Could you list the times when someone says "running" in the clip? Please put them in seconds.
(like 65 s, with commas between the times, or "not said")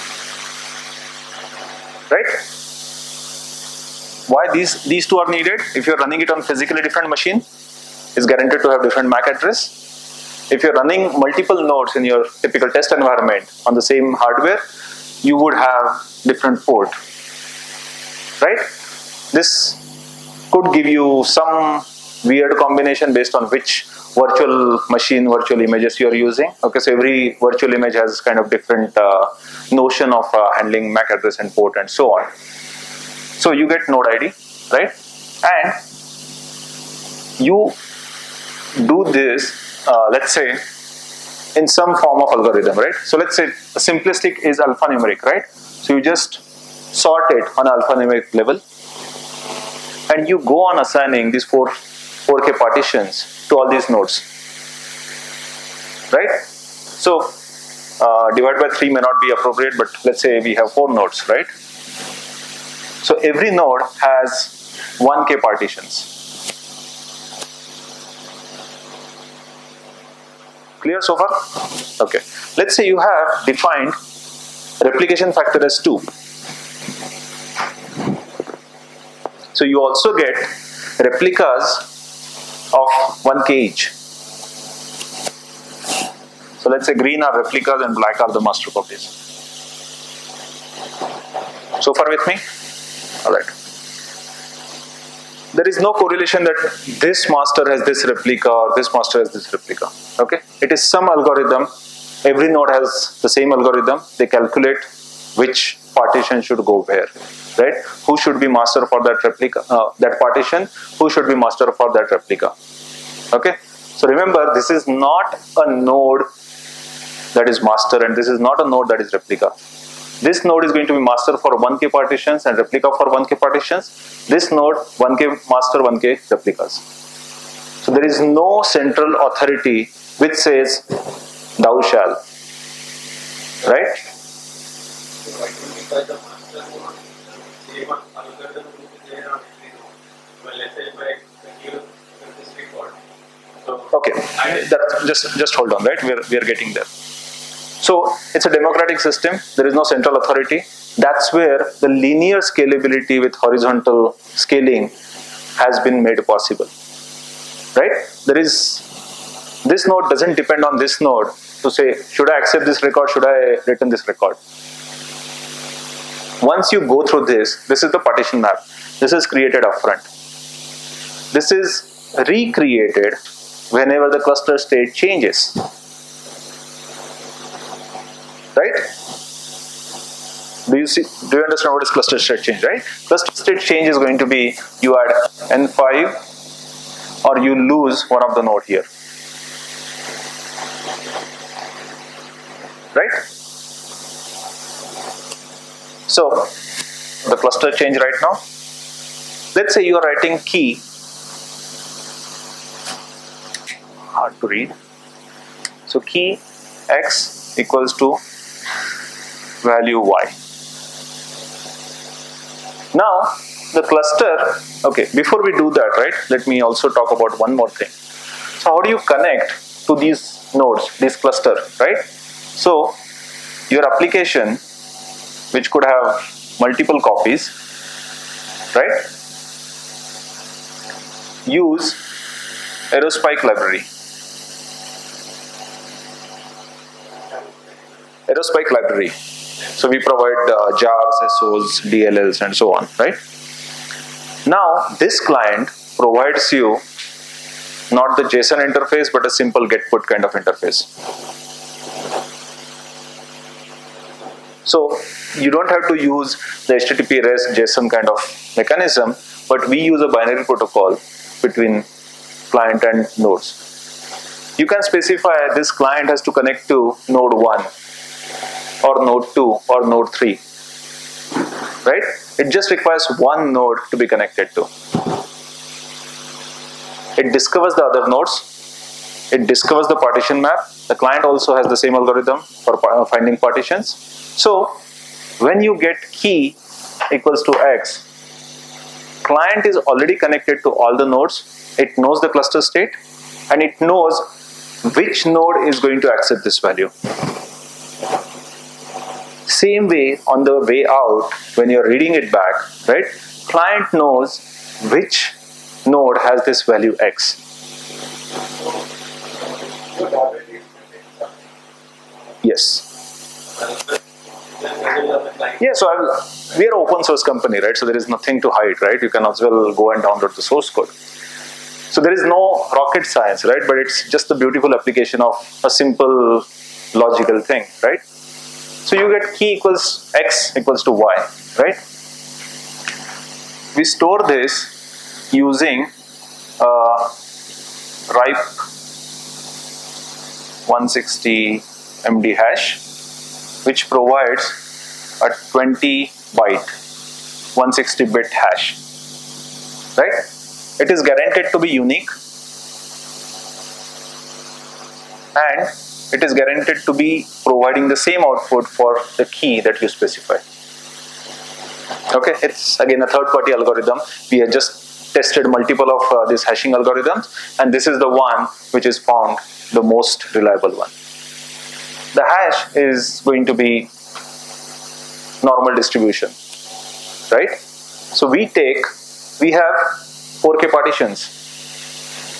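5 s, 10 s.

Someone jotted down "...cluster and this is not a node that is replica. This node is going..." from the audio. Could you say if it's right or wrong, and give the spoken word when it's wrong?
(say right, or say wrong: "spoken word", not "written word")
wrong: "master", not "cluster".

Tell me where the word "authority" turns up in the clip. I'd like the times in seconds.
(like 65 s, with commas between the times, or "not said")
129 s, 150 s.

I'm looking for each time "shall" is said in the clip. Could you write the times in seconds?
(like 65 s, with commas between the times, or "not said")
131 s.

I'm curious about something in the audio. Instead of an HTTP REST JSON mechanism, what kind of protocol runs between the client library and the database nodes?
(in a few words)
Binary protocol.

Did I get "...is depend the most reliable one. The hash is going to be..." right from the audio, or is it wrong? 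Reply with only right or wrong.
wrong.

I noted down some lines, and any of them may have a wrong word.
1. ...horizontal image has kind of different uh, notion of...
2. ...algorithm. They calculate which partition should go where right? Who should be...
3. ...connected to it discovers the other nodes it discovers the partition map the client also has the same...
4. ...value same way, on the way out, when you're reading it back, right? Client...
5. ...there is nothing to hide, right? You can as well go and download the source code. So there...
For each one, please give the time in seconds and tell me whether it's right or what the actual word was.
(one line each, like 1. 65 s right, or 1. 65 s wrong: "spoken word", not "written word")
1. 27 s wrong: "virtual", not "horizontal"
2. 103 s right
3. 274 s right
4. 296 s right
5. 317 s right.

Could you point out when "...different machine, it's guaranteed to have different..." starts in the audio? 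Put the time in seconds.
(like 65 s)
6 s.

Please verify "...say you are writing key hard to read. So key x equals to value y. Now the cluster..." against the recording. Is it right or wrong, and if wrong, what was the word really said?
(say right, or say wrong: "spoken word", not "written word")
right.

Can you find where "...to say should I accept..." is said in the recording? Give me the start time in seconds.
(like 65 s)
161 s.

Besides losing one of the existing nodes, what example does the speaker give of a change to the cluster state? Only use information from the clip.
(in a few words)
Adding n5.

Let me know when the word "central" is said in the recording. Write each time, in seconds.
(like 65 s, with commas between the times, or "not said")
128 s, 149 s.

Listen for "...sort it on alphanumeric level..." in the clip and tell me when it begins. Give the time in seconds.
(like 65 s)
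47 s.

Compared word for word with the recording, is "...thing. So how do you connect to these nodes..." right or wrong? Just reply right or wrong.
right.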